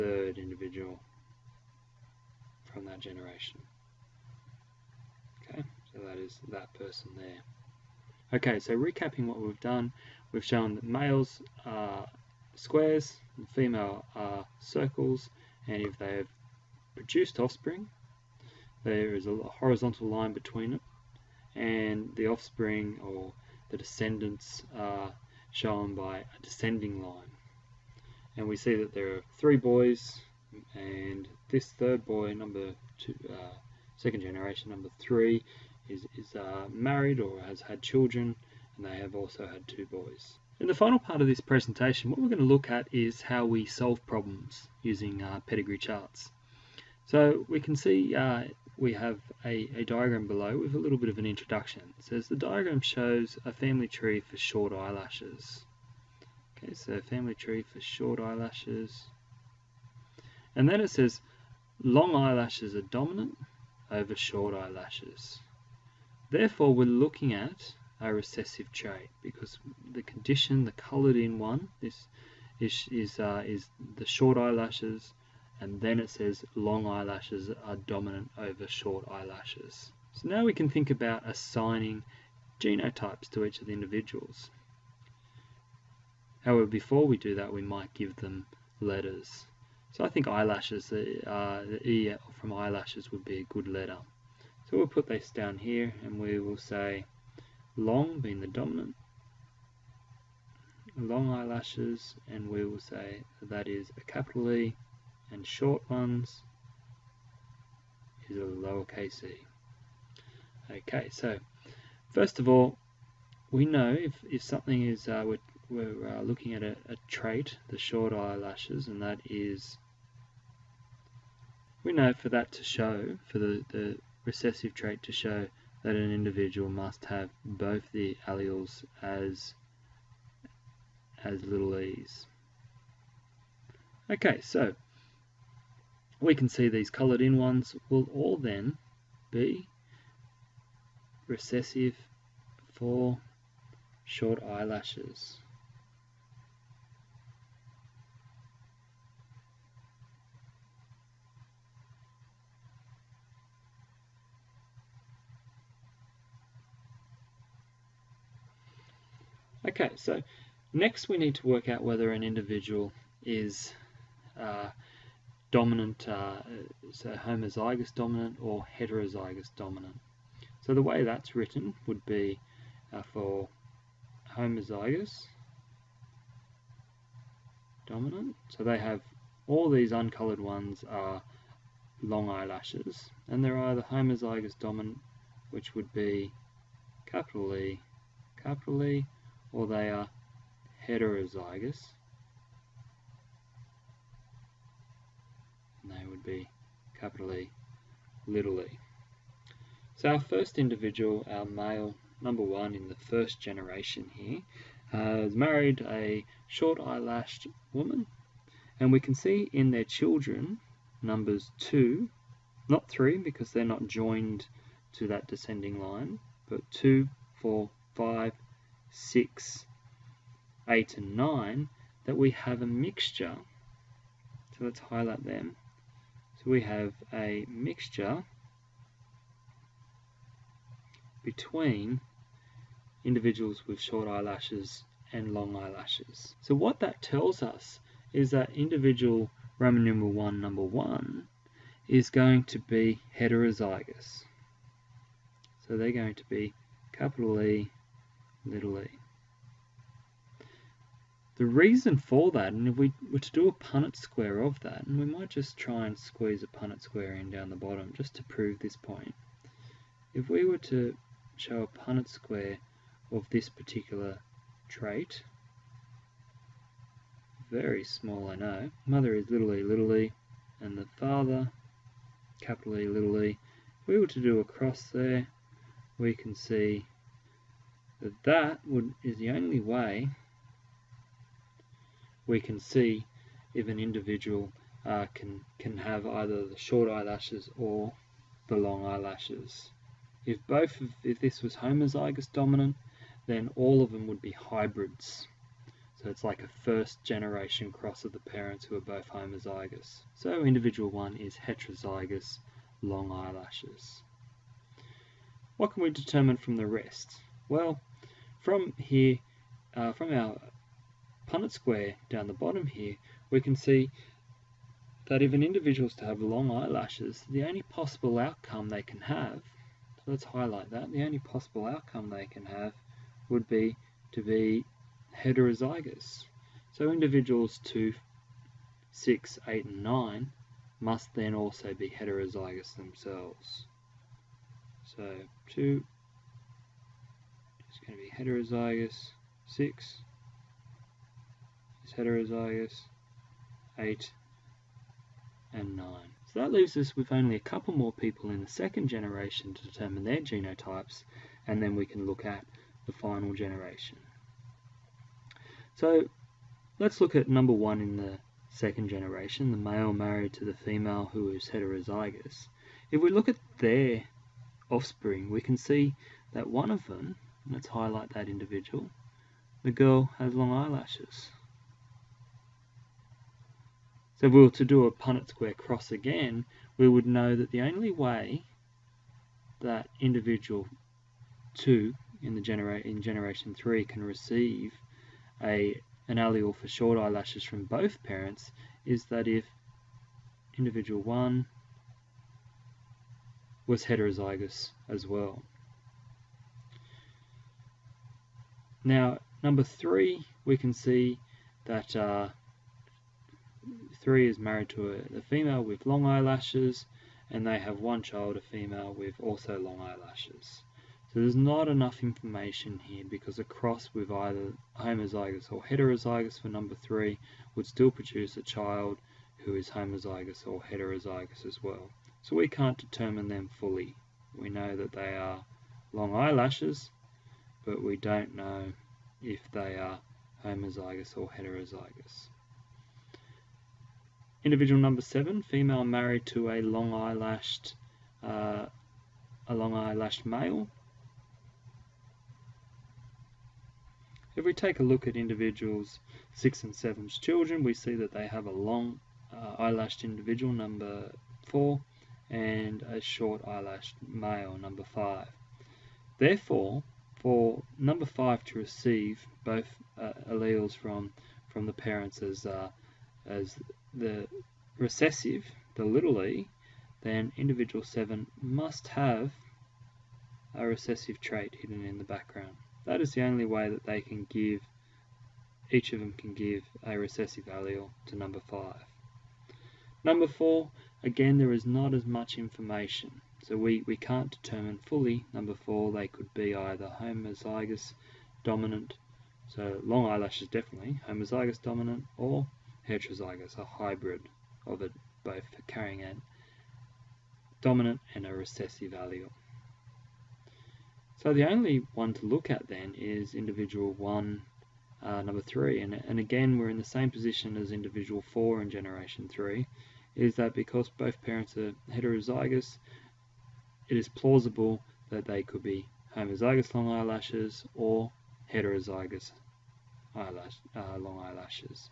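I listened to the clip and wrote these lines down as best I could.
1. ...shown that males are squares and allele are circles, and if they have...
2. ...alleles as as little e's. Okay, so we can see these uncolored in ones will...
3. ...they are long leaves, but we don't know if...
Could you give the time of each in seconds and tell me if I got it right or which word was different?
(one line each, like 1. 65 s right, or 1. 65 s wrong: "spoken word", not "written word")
1. 10 s wrong: "female", not "allele"
2. 128 s wrong: "coloured", not "uncolored"
3. 424 s wrong: "eyelashes", not "leaves".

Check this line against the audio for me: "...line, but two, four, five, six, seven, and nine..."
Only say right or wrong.
wrong.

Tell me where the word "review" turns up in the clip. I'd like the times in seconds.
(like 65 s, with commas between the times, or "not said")
not said.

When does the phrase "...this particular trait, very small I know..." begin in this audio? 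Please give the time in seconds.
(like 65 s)
263 s.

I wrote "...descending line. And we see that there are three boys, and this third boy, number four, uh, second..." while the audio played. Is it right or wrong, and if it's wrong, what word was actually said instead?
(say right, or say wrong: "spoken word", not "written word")
wrong: "two", not "four".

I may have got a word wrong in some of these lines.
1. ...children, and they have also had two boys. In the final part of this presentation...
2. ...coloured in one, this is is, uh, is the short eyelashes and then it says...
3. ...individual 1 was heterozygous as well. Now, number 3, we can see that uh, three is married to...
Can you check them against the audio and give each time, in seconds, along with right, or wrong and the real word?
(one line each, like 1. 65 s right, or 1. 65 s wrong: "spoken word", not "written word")
1. 37 s right
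2. 70 s right
3. 390 s right.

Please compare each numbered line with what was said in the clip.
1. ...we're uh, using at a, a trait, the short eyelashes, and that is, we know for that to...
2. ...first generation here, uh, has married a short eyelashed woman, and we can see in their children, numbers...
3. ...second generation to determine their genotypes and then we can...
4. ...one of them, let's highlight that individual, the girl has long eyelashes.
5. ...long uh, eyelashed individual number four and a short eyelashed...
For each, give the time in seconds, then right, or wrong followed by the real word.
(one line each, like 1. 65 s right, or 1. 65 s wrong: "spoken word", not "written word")
1. 115 s wrong: "looking", not "using"
2. 202 s right
3. 348 s right
4. 366 s right
5. 448 s right.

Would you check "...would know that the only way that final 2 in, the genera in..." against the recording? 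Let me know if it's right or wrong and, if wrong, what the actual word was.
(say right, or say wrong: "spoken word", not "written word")
wrong: "individual", not "final".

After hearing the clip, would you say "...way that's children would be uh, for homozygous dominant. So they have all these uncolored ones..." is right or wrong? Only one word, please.
wrong.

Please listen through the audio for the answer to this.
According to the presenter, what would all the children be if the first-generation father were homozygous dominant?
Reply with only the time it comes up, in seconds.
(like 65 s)
294 s.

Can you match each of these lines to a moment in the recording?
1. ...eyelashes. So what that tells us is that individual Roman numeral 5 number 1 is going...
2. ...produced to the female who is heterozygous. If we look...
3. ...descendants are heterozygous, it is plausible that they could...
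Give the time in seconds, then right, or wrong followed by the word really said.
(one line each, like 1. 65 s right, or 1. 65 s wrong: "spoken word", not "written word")
1. 235 s wrong: "1", not "5"
2. 359 s wrong: "married", not "produced"
3. 511 s wrong: "parents", not "descendants".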